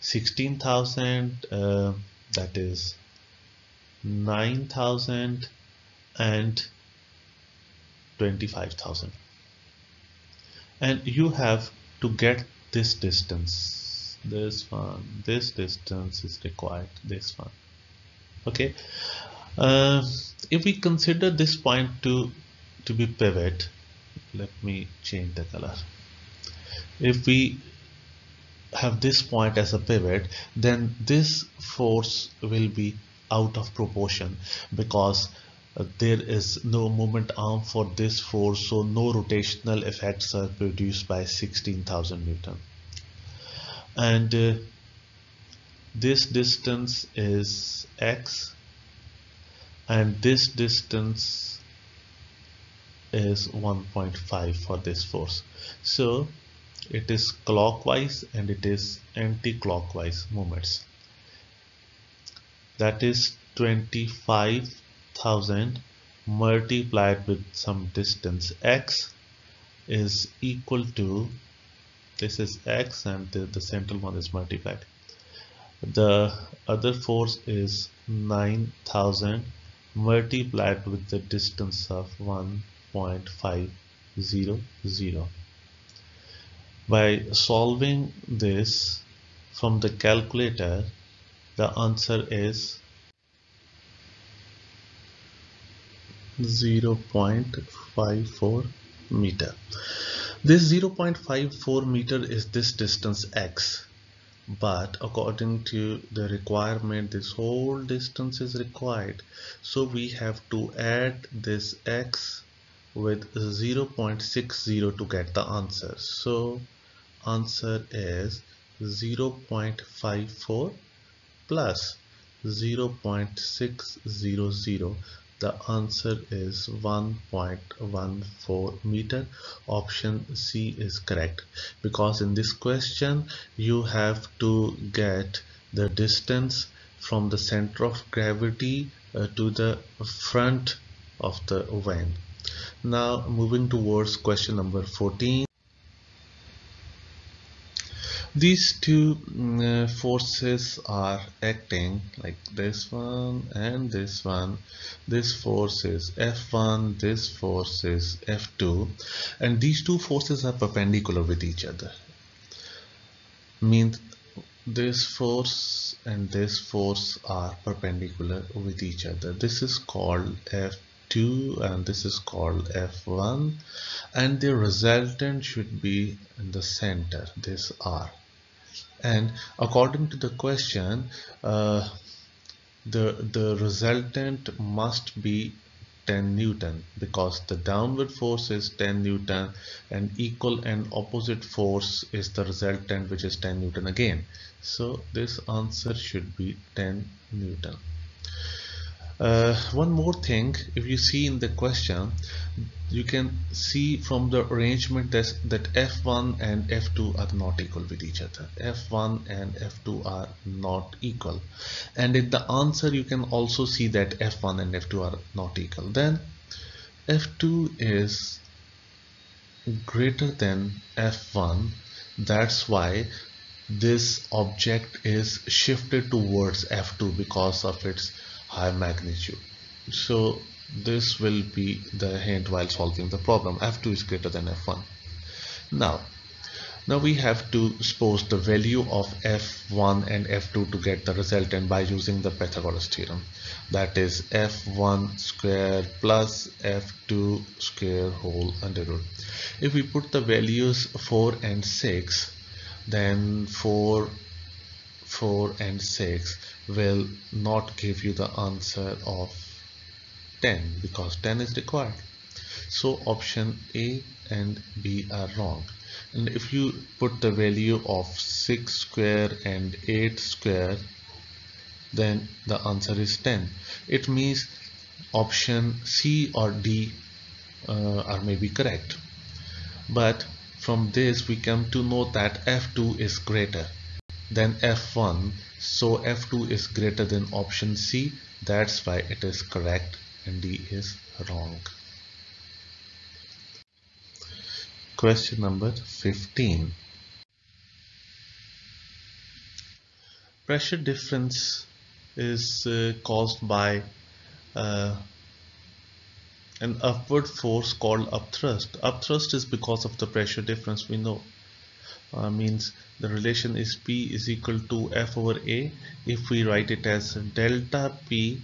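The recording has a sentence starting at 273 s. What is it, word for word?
It means option C or D uh, are maybe correct.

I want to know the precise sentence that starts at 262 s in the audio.
So option A and B are wrong.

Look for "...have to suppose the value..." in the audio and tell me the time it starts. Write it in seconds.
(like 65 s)
237 s.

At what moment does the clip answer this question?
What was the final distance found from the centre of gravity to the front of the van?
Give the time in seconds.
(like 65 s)
126 s.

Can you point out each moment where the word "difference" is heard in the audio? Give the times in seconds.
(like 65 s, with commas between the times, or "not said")
300 s, 310 s.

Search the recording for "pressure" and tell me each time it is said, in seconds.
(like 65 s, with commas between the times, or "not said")
300 s, 310 s.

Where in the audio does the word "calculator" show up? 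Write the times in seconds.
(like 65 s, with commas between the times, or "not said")
89 s.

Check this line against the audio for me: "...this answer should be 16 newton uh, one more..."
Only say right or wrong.
wrong.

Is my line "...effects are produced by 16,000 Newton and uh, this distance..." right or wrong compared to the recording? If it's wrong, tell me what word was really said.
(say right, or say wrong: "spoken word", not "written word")
right.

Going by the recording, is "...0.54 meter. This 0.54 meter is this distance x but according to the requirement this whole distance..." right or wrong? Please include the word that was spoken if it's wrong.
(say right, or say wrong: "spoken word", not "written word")
right.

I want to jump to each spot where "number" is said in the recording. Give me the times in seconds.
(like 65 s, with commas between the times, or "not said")
144 s, 295 s.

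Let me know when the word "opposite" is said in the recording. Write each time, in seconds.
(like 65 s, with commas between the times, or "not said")
191 s.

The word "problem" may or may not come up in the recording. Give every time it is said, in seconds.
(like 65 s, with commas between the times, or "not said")
233 s.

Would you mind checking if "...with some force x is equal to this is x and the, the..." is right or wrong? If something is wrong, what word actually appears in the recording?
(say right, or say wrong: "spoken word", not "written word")
wrong: "distance", not "force".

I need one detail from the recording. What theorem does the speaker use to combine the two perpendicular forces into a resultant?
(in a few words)
Pythagoras theorem.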